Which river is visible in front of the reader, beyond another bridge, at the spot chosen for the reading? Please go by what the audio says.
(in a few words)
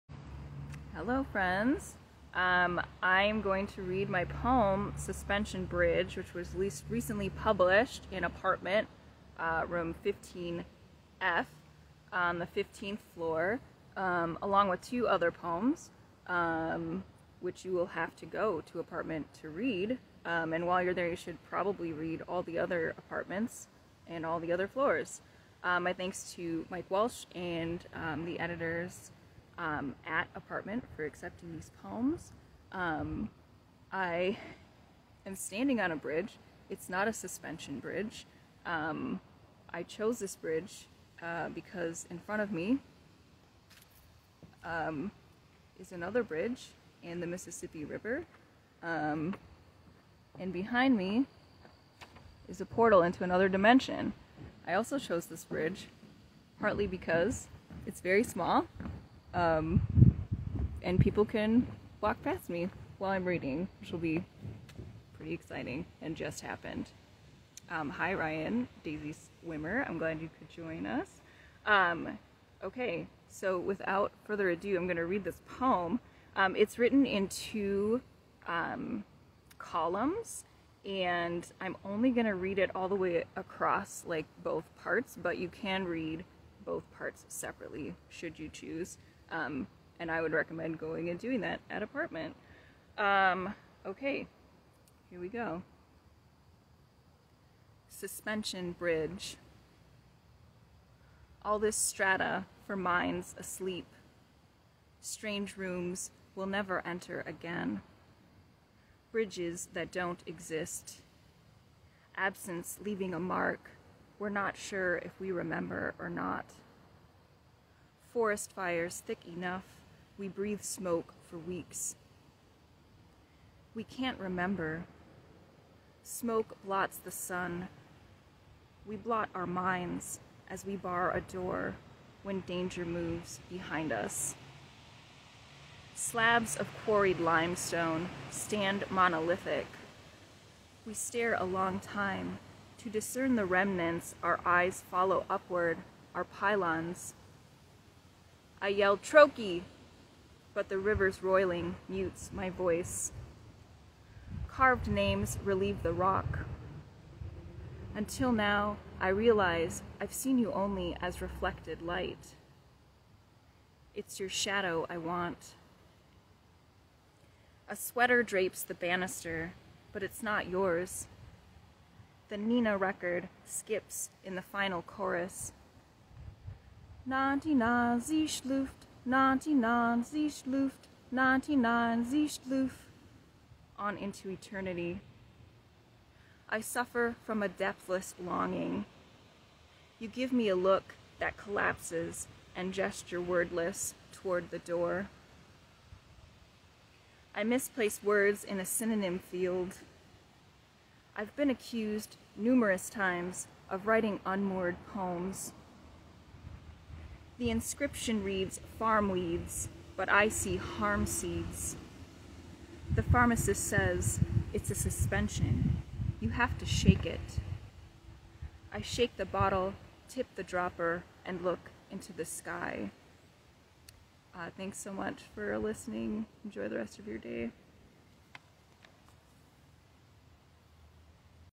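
Mississippi River.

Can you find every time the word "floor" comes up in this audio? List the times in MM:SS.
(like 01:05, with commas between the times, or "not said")
00:13, 00:24.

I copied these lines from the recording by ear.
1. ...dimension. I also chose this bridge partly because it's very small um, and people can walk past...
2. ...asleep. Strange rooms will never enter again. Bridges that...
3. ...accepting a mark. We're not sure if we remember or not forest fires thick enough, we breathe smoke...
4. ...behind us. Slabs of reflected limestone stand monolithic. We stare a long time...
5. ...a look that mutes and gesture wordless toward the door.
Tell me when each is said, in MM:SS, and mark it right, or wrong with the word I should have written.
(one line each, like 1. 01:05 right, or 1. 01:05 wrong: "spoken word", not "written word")
1. 00:53 right
2. 01:43 right
3. 01:52 wrong: "leaving", not "accepting"
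4. 02:13 wrong: "quarried", not "reflected"
5. 03:10 wrong: "collapses", not "mutes".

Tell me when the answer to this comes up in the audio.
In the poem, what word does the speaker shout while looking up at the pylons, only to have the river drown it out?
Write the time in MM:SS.
02:28.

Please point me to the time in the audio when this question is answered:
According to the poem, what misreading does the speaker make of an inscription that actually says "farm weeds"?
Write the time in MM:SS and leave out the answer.
03:30.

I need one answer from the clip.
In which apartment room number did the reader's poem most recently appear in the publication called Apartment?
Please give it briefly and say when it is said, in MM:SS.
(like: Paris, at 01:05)
15F, at 00:09.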